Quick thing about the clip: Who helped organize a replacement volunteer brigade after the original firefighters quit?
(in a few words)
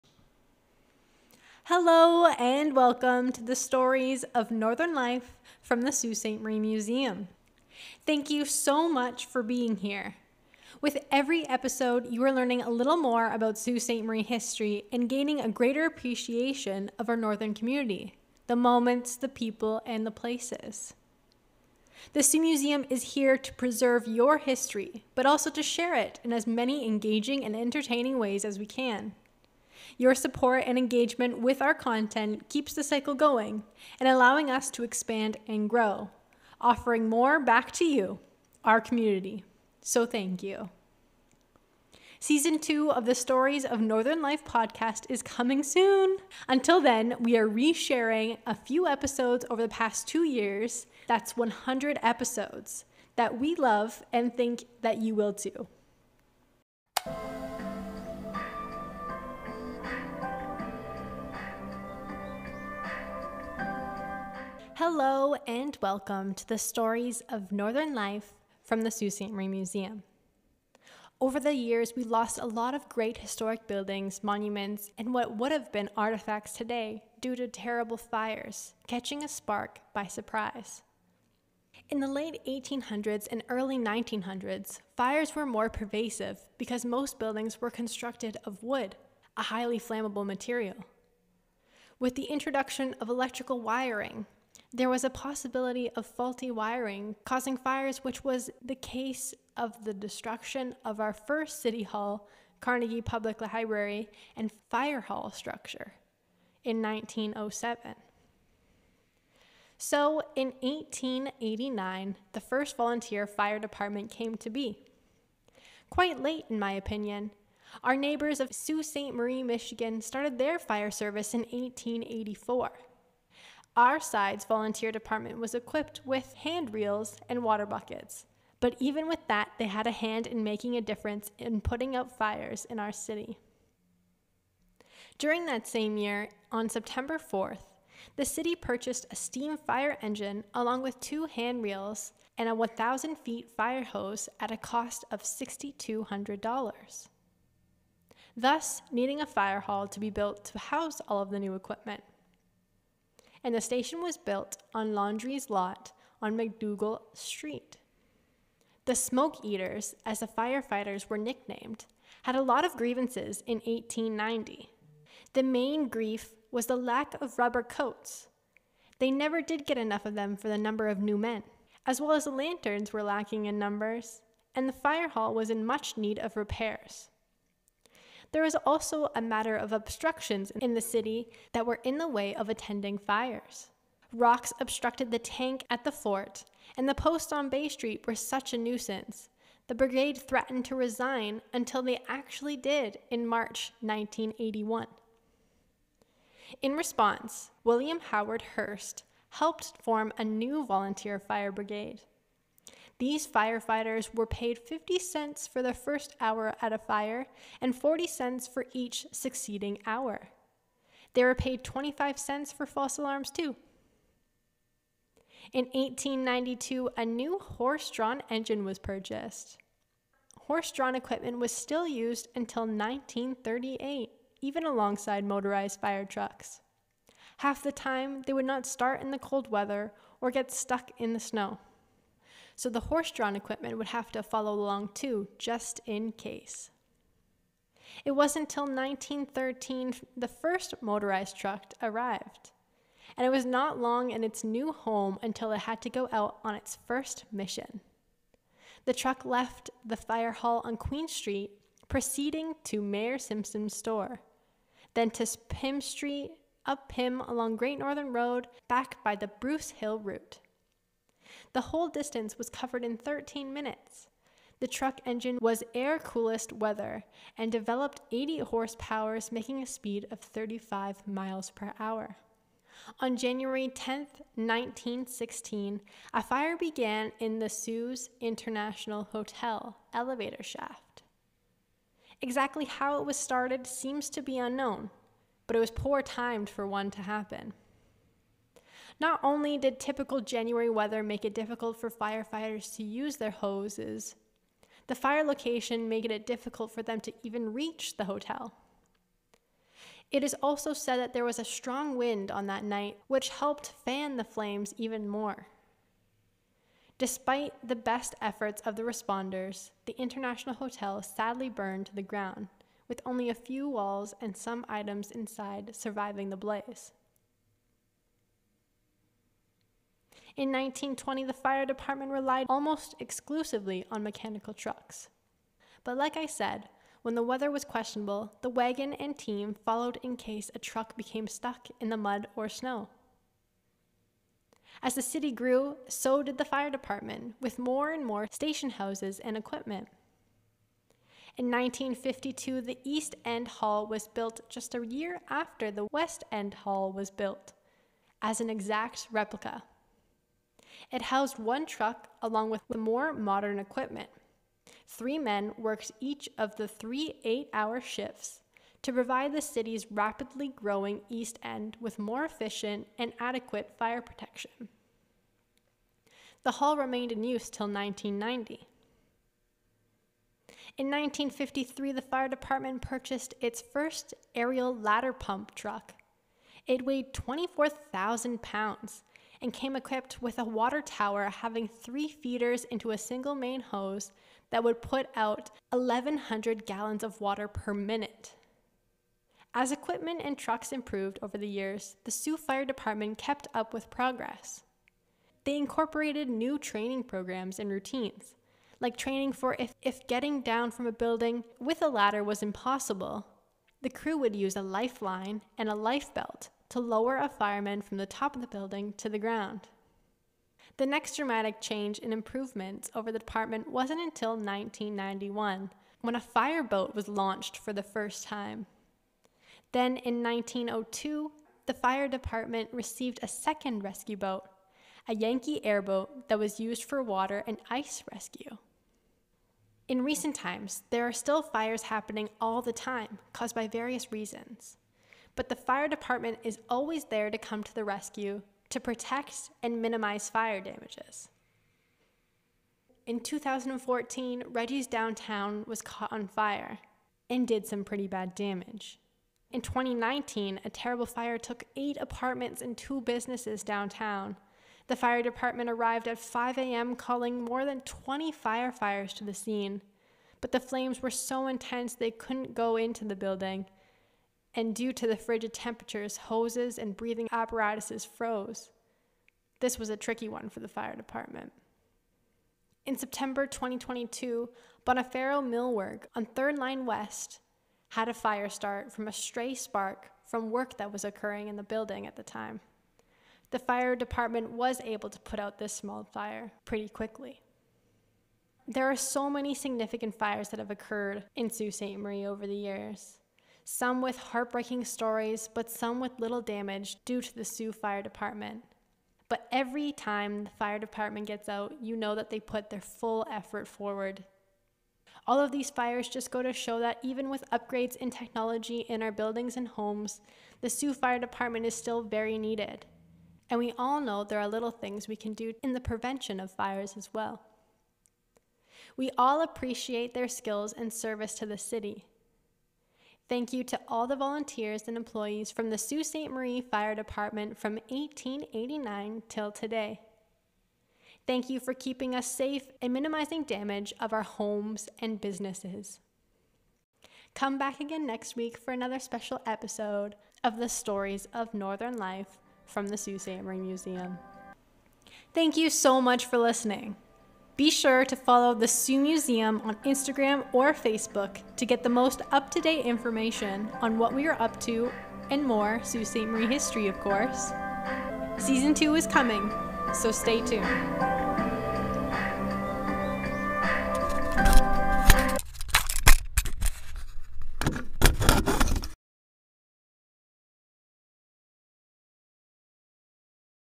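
William Howard Hearst.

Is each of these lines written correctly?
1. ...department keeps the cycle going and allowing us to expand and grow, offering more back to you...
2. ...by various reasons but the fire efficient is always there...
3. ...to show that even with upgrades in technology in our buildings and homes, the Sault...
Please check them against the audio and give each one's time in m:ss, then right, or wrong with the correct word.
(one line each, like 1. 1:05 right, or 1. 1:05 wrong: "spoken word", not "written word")
1. 0:31 wrong: "content", not "department"
2. 7:13 wrong: "department", not "efficient"
3. 8:26 right.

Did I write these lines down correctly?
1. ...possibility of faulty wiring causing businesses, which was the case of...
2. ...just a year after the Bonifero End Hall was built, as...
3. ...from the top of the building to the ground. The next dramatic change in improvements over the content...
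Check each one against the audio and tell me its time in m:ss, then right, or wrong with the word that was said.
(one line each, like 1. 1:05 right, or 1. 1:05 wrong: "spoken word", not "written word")
1. 1:35 wrong: "fires", not "businesses"
2. 5:44 wrong: "West", not "Bonifero"
3. 6:47 wrong: "department", not "content".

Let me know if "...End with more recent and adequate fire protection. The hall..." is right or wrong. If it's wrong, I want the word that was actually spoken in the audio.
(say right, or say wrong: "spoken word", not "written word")
wrong: "efficient", not "recent".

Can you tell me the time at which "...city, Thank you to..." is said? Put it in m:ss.
8:41.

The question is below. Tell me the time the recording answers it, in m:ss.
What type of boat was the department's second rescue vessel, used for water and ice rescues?
7:05.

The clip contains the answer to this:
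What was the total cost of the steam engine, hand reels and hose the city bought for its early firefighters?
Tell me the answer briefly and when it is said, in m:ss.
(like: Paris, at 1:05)
$6,200, at 2:25.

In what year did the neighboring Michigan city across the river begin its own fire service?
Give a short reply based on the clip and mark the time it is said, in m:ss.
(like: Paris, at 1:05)
1884, at 2:01.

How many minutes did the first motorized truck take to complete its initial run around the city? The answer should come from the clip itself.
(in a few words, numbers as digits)
13.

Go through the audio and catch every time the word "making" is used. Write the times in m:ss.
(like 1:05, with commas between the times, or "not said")
2:10, 4:29.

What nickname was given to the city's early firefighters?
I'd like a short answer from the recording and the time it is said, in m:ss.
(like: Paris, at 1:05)
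The Smoke Eaters, at 2:38.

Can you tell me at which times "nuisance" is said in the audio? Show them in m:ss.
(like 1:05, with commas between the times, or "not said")
3:08.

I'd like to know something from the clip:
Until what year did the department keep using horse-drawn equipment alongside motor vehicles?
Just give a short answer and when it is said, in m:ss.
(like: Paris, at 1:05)
1938, at 3:42.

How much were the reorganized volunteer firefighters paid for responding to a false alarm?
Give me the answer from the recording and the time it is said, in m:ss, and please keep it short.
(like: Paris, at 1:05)
25 cents, at 3:31.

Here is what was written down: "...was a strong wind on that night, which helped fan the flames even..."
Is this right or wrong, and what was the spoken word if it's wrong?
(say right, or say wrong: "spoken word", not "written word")
right.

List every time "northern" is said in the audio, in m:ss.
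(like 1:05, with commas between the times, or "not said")
0:04, 0:17, 0:43, 1:07, 4:17, 9:01.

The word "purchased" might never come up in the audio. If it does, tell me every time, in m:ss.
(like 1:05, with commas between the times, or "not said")
2:18, 3:38, 6:12.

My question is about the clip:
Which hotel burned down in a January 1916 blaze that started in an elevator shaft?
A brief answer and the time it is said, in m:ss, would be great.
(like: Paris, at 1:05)
Sault International Hotel, at 4:37.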